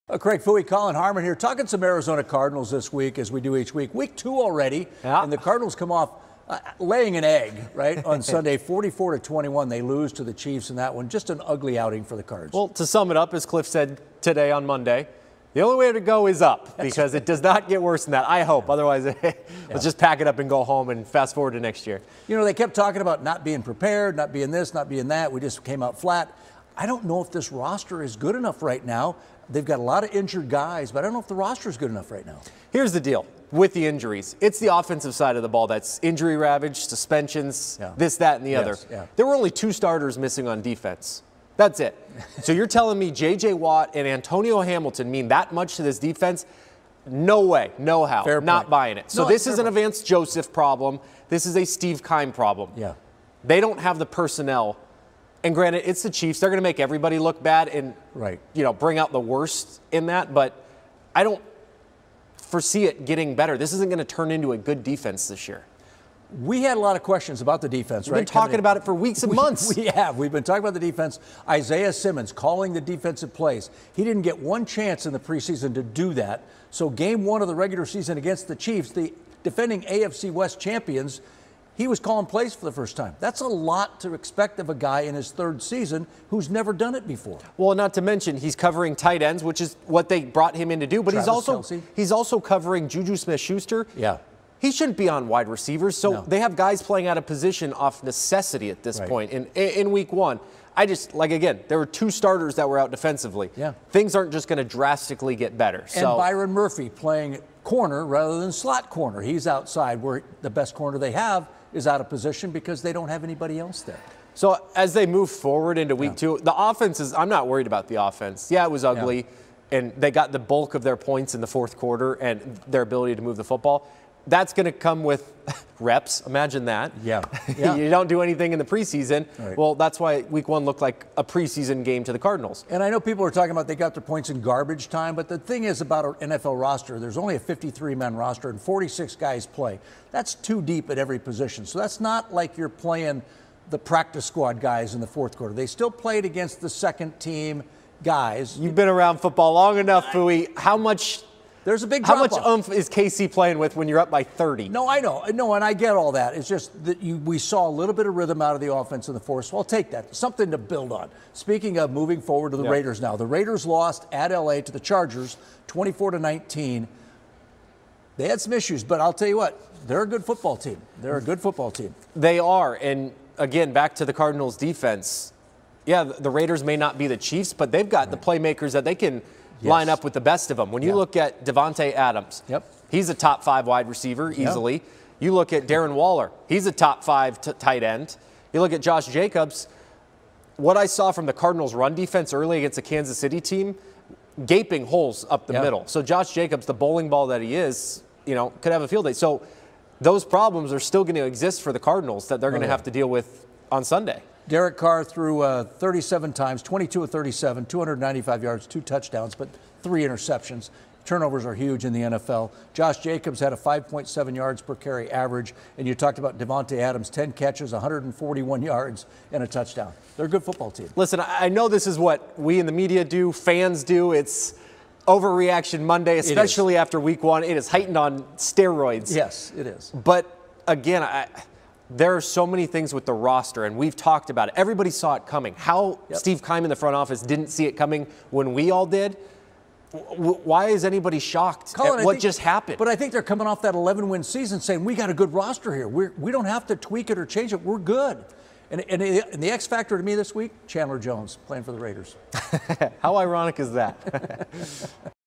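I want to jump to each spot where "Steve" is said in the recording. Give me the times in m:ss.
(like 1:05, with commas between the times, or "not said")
0:51, 3:56.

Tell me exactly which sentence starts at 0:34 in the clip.
It's the offensive side of the ball that's injury ravaged, suspensions, yeah.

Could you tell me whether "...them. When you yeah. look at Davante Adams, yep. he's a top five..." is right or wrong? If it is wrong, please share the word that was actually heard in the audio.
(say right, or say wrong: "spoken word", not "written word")
right.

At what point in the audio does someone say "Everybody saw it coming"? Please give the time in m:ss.
3:54.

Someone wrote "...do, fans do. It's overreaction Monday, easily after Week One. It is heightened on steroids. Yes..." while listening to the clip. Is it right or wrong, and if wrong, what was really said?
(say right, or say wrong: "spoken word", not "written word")
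wrong: "especially", not "easily".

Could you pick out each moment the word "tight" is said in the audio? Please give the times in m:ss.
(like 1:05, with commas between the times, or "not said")
1:28, 3:07.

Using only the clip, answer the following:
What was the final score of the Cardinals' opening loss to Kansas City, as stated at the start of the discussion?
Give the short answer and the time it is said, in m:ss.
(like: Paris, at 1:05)
44 to 21, at 0:08.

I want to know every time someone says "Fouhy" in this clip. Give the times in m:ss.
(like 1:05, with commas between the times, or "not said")
0:00, 2:30.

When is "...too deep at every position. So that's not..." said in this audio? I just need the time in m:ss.
2:20.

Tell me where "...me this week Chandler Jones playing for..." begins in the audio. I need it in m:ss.
4:10.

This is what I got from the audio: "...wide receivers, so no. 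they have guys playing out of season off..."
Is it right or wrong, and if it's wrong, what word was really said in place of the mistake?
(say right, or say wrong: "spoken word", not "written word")
wrong: "position", not "season".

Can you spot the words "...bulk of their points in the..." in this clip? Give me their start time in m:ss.
2:00.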